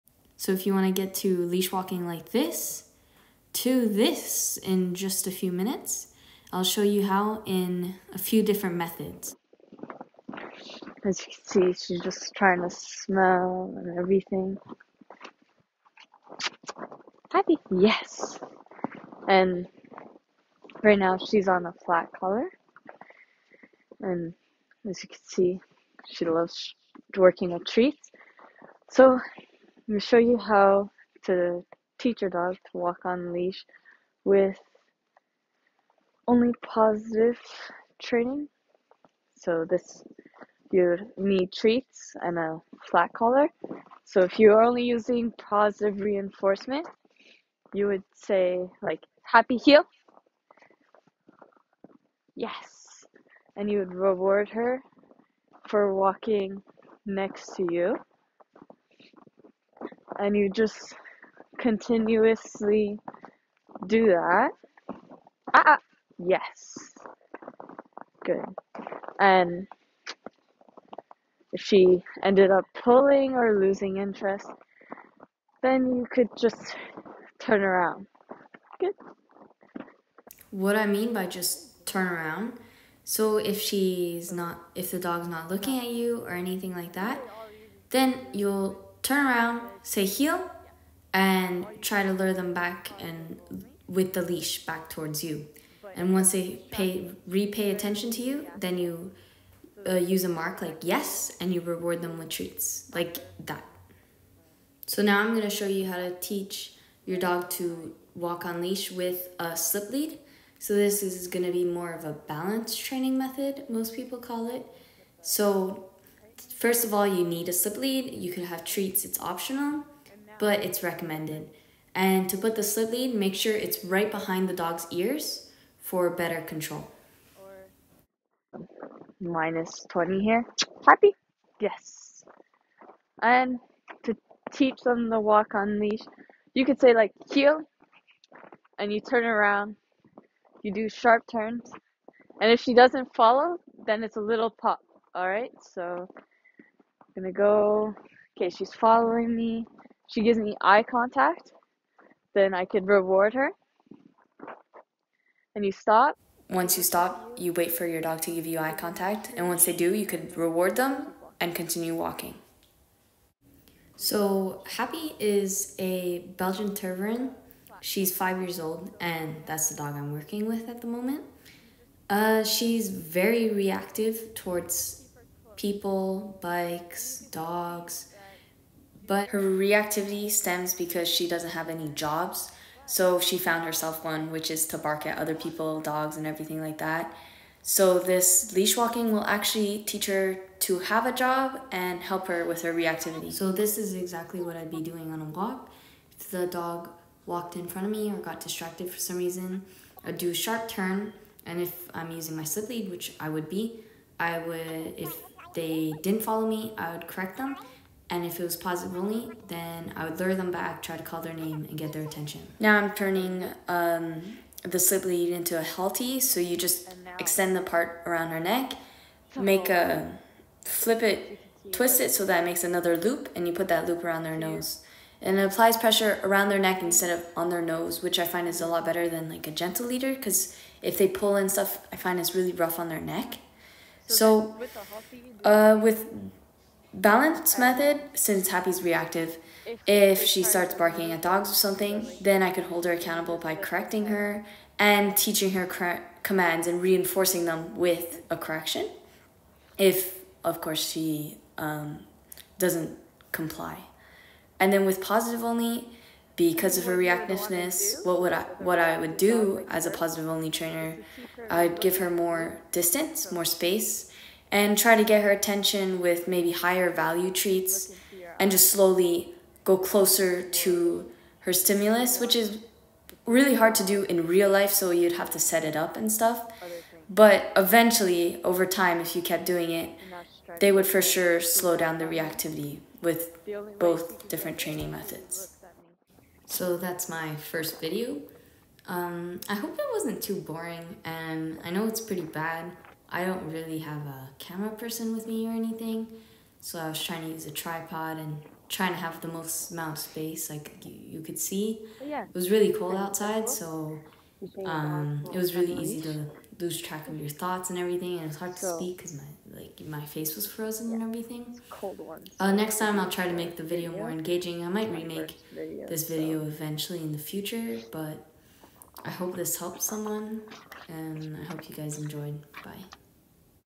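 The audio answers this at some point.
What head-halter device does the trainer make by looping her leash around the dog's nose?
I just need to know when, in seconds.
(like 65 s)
215 s.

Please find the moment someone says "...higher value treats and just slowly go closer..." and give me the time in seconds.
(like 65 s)
266 s.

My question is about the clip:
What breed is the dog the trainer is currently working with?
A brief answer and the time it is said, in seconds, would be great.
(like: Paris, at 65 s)
Belgian Tervuren, at 166 s.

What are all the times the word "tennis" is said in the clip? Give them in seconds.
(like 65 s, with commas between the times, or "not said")
not said.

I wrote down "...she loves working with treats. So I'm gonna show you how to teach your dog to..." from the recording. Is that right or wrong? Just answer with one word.
right.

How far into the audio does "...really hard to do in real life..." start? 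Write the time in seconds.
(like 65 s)
273 s.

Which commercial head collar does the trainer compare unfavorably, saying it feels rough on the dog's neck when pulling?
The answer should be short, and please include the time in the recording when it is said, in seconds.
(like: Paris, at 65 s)
gentle leader, at 229 s.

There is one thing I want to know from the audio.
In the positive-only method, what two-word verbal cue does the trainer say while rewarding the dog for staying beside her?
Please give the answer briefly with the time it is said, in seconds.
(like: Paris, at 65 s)
happy heel, at 49 s.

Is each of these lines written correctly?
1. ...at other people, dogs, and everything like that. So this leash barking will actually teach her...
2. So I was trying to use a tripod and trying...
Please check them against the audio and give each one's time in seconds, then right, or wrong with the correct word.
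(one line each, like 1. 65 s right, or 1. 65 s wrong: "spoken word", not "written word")
1. 185 s wrong: "walking", not "barking"
2. 296 s right.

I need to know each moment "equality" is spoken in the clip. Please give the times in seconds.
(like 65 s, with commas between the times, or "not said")
not said.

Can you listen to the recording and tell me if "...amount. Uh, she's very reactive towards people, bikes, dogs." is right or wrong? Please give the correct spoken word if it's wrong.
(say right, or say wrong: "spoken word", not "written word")
wrong: "moment", not "amount".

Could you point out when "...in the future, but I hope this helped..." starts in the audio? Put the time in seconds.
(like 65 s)
316 s.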